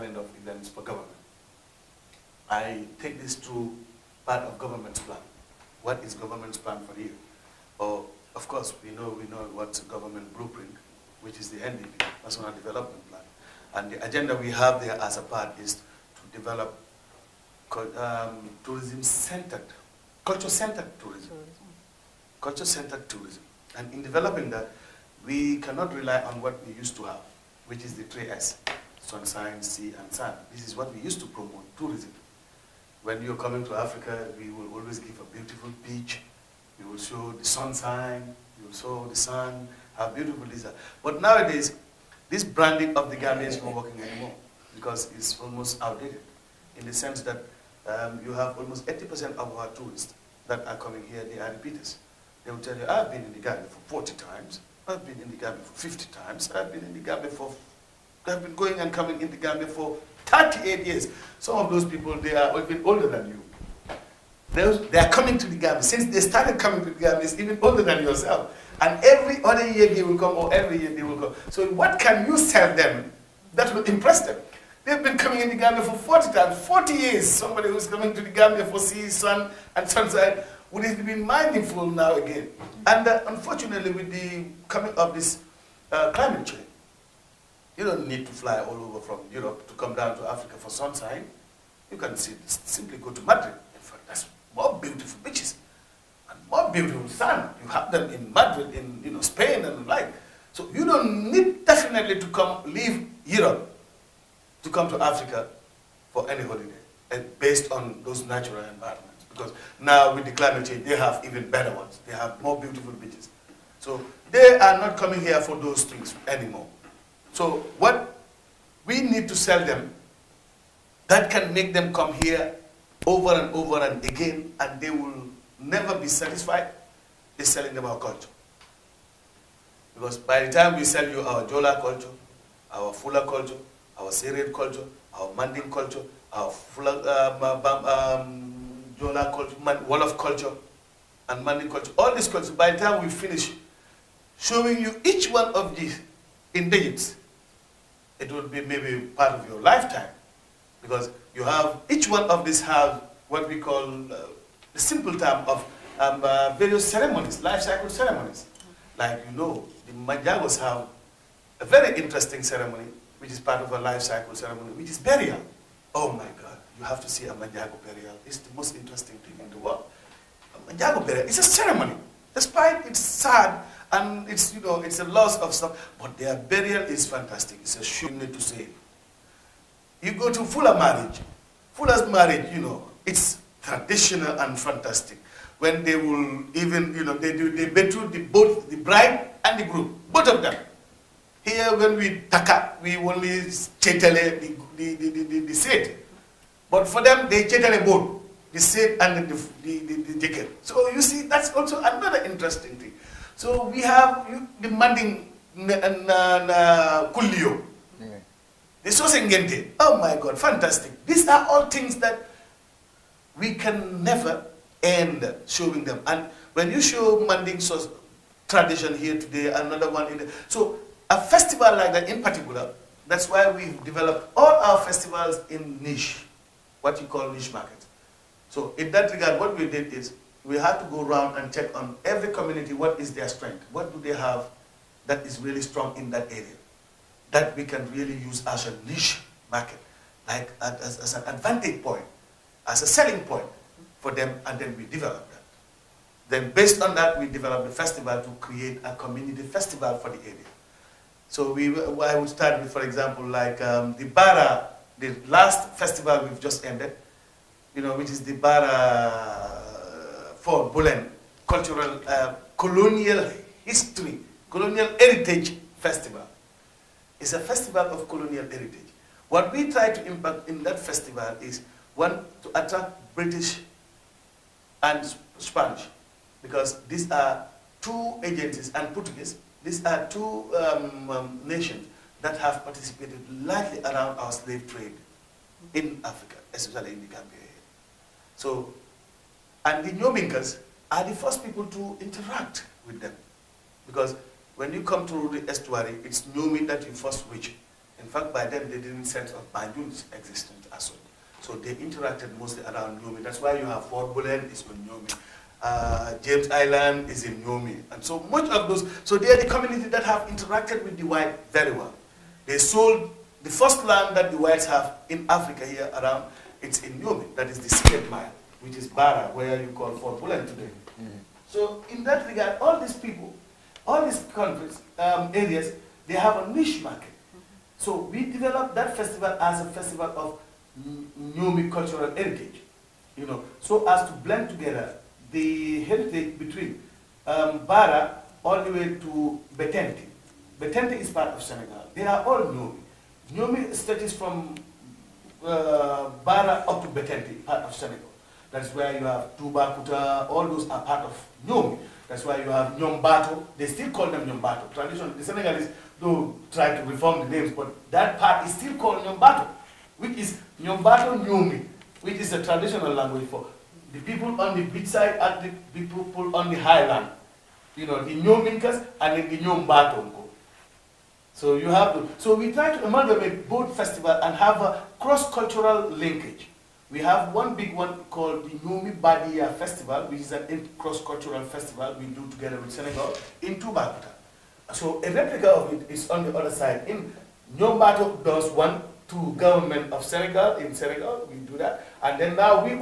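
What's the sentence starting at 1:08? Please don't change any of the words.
And every other year they will come, or every year they will come.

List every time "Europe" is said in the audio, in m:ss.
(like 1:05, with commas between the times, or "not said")
1:29, 1:43.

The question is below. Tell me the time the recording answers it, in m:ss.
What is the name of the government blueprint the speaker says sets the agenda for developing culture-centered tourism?
0:12.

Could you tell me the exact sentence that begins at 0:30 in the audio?
This is what we used to promote, tourism.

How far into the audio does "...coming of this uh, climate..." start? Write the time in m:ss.
1:24.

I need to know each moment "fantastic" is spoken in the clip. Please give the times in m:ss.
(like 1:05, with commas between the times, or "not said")
2:57, 3:04, 3:30.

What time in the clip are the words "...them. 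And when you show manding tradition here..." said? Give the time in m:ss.
3:35.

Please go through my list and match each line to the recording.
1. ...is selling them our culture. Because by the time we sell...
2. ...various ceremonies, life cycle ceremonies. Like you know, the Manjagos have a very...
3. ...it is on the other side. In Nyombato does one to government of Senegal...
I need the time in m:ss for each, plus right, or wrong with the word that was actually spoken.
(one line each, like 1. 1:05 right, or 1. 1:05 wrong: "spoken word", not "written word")
1. 2:07 right
2. 2:36 right
3. 6:25 right.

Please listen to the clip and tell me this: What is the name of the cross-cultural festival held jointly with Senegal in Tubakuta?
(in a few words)
Nyomi Badia Festival.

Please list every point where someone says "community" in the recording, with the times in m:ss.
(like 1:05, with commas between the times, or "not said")
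3:52, 4:08, 5:09.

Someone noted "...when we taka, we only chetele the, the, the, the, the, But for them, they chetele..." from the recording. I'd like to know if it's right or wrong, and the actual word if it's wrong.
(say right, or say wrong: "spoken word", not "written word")
right.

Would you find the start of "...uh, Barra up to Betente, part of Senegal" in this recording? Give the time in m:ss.
5:45.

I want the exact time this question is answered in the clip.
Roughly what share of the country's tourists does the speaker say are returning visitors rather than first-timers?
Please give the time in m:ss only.
0:48.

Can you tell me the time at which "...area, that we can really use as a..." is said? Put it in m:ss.
3:56.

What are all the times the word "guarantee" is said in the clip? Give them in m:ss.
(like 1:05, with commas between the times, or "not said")
not said.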